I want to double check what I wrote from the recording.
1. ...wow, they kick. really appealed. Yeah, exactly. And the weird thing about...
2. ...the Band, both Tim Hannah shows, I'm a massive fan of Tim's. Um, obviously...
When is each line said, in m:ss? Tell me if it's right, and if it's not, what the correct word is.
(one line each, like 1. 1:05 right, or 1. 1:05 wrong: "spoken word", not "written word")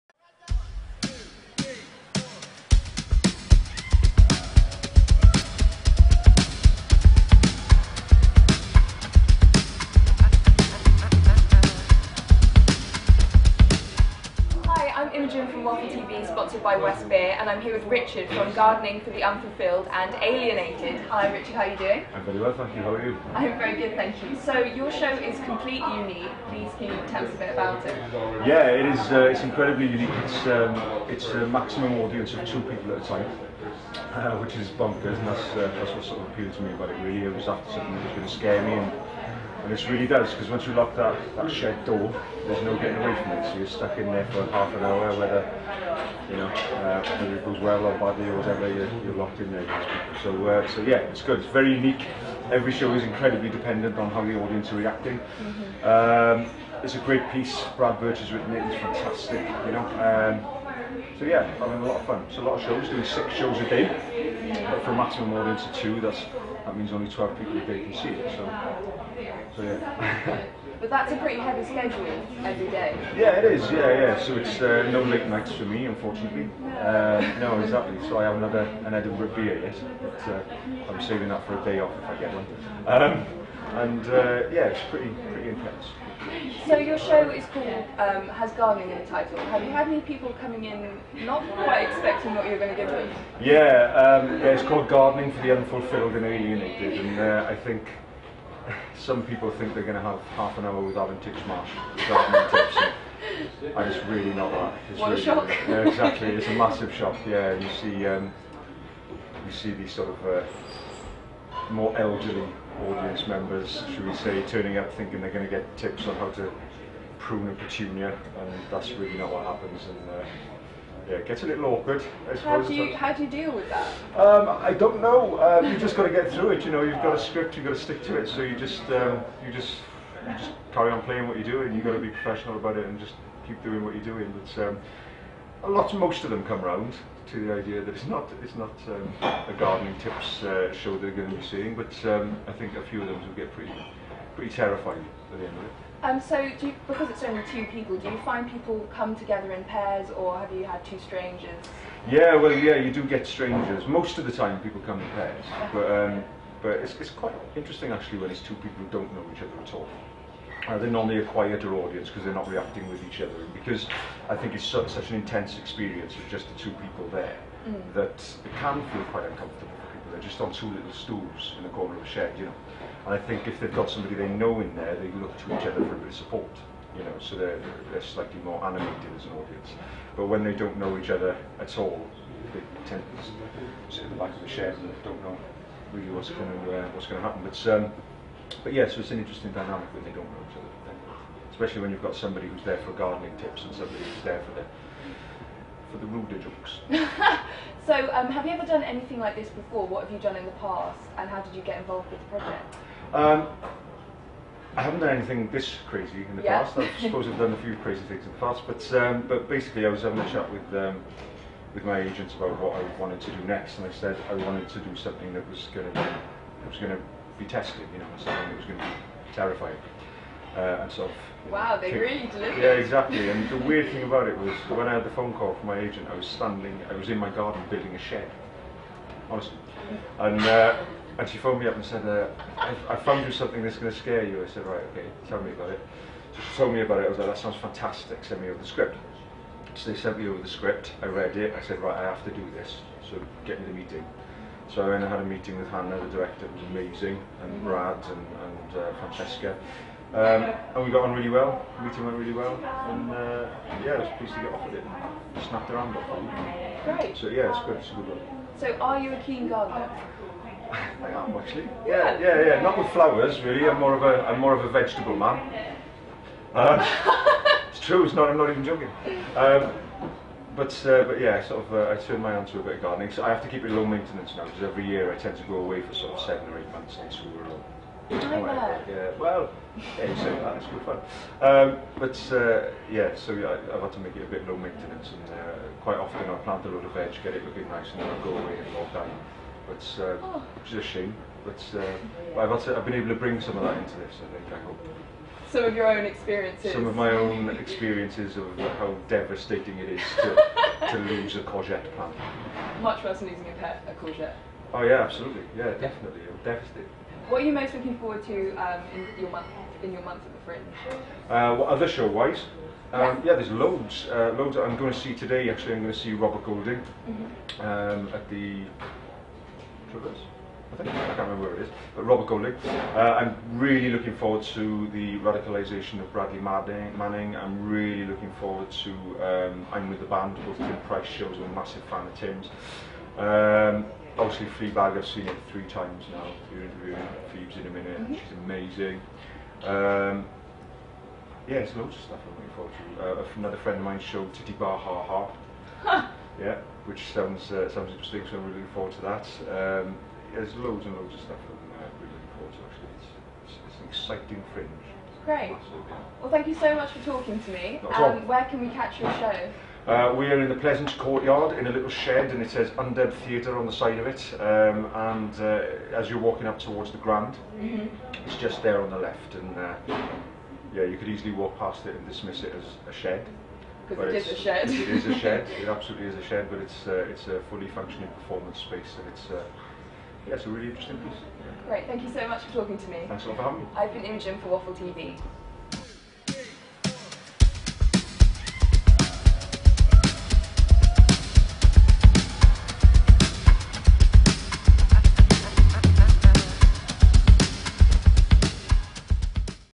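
1. 3:41 wrong: "delivered", not "appealed"
2. 5:29 wrong: "Price", not "Hannah".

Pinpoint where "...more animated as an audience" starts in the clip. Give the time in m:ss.
2:58.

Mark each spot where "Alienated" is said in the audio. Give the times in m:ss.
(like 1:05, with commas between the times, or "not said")
0:20, 1:36.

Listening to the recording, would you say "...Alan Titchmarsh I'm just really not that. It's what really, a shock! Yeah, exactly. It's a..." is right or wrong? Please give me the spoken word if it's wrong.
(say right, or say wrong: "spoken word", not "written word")
right.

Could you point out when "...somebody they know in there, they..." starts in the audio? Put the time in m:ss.
2:53.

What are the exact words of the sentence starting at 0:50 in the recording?
So, uh, so yeah, it's good.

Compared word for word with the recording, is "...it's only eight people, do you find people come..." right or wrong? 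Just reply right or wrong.
wrong.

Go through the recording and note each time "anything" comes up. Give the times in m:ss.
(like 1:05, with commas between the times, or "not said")
3:18, 3:25.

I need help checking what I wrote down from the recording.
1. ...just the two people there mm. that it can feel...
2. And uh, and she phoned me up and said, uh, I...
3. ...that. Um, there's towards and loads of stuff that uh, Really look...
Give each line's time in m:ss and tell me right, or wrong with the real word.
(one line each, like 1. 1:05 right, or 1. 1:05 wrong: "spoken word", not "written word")
1. 2:46 right
2. 3:50 right
3. 5:49 wrong: "loads", not "towards".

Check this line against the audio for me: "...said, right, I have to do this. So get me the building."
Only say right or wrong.
wrong.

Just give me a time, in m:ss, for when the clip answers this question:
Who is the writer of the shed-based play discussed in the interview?
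0:57.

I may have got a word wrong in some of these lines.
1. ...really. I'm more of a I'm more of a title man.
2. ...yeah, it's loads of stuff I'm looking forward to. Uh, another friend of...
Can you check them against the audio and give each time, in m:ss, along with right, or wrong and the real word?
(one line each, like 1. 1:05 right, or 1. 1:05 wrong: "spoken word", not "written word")
1. 4:23 wrong: "vegetable", not "title"
2. 5:41 right.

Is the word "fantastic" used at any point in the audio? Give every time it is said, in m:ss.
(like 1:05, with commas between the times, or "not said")
0:58, 3:57.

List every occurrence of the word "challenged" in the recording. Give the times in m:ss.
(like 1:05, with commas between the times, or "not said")
not said.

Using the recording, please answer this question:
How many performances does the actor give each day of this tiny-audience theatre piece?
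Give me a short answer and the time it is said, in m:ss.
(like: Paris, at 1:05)
6, at 1:03.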